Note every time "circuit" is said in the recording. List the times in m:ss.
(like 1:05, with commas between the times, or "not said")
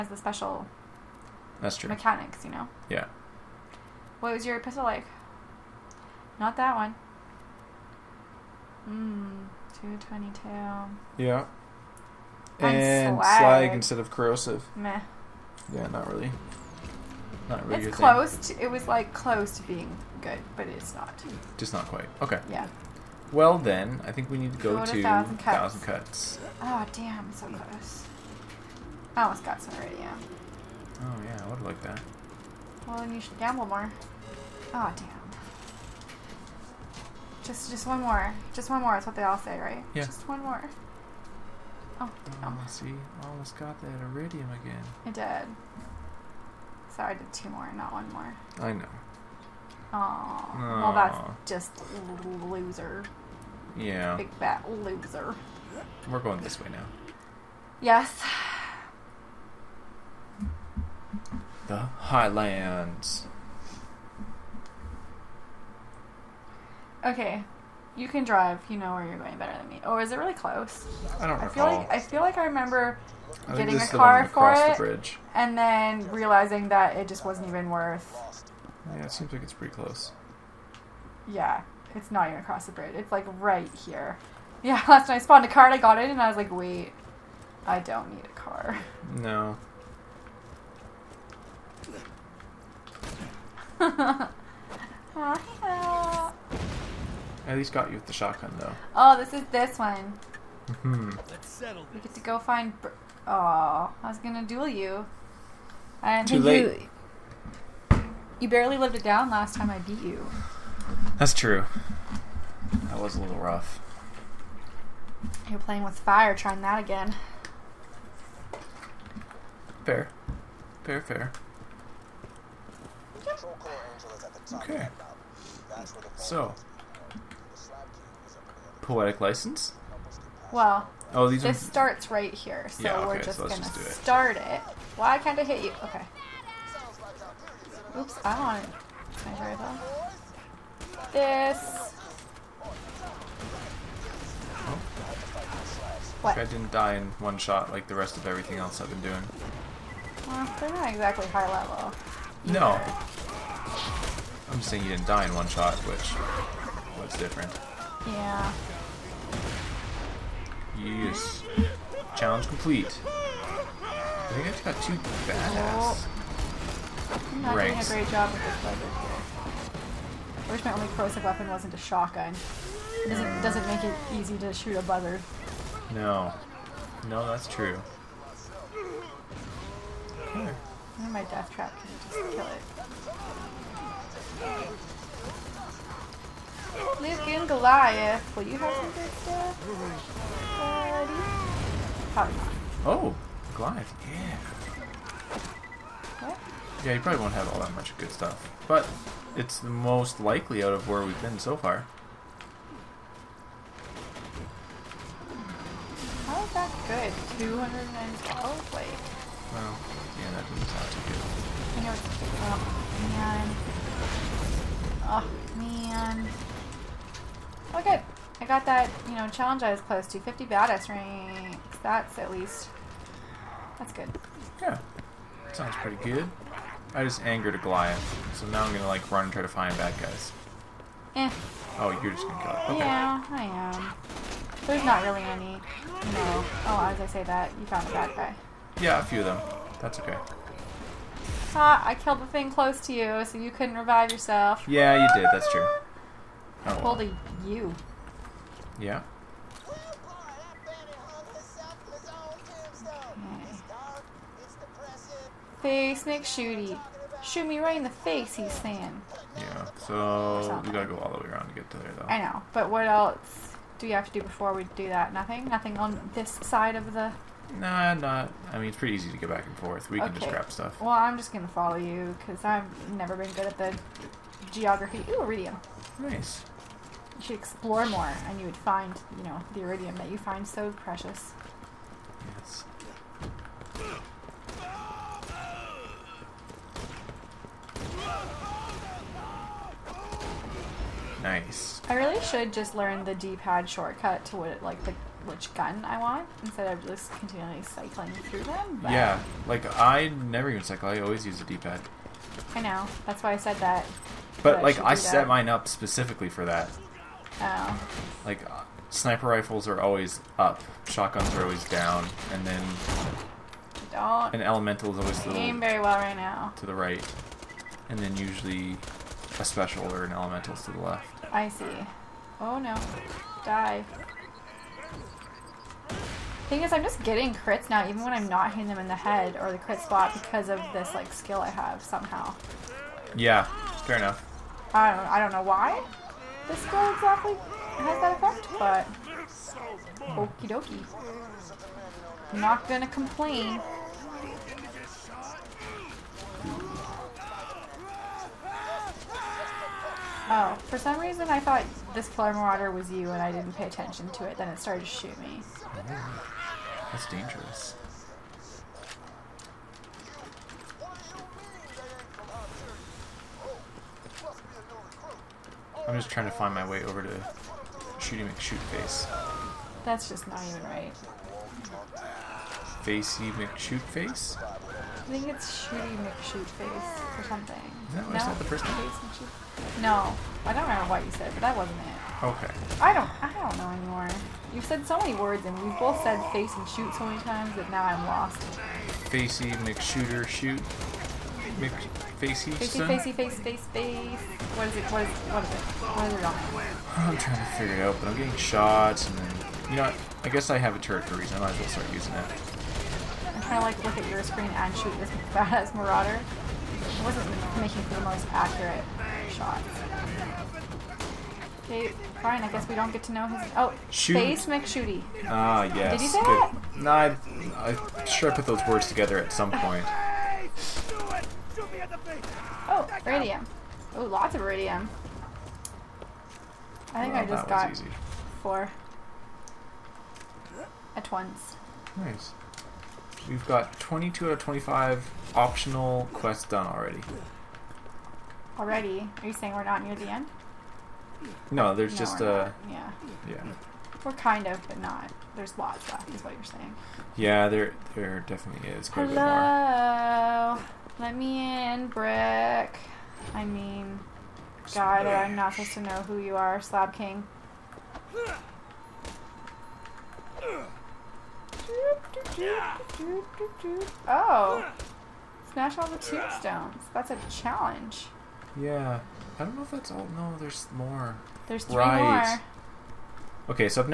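not said.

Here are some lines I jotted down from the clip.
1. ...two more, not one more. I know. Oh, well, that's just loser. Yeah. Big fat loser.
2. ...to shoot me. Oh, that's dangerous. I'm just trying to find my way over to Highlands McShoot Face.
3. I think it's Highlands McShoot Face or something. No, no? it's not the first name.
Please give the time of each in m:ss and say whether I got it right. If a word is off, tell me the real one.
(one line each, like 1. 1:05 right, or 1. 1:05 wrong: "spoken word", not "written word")
1. 0:47 right
2. 5:54 wrong: "Shooty", not "Highlands"
3. 6:15 wrong: "Shooty", not "Highlands".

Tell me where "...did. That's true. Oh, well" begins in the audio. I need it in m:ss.
4:05.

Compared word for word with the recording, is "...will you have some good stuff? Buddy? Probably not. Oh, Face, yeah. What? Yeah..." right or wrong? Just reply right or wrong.
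wrong.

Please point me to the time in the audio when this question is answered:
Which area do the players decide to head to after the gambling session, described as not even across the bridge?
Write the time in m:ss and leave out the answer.
1:01.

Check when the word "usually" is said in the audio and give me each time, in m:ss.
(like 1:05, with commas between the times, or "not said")
5:18.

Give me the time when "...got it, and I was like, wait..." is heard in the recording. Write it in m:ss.
1:25.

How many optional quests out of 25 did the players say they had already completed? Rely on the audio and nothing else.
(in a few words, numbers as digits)
22.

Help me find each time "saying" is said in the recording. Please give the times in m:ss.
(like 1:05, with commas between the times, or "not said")
2:34, 4:18, 7:19, 7:26.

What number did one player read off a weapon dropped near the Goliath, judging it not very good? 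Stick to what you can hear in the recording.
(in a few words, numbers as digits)
212.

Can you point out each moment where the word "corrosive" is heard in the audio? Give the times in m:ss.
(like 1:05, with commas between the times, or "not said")
0:14, 2:50.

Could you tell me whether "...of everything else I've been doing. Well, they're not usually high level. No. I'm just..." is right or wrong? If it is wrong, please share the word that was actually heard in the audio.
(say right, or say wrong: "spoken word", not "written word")
wrong: "exactly", not "usually".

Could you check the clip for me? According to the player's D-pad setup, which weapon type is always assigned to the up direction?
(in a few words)
sniper rifles.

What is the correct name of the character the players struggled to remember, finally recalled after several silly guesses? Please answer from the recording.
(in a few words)
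Face McShooty.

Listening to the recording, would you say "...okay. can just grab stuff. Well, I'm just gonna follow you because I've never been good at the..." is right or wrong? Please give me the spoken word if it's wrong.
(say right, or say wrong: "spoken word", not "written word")
right.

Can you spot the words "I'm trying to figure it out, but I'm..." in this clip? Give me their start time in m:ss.
6:36.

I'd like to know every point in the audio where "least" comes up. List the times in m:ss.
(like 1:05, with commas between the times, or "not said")
1:37, 3:42.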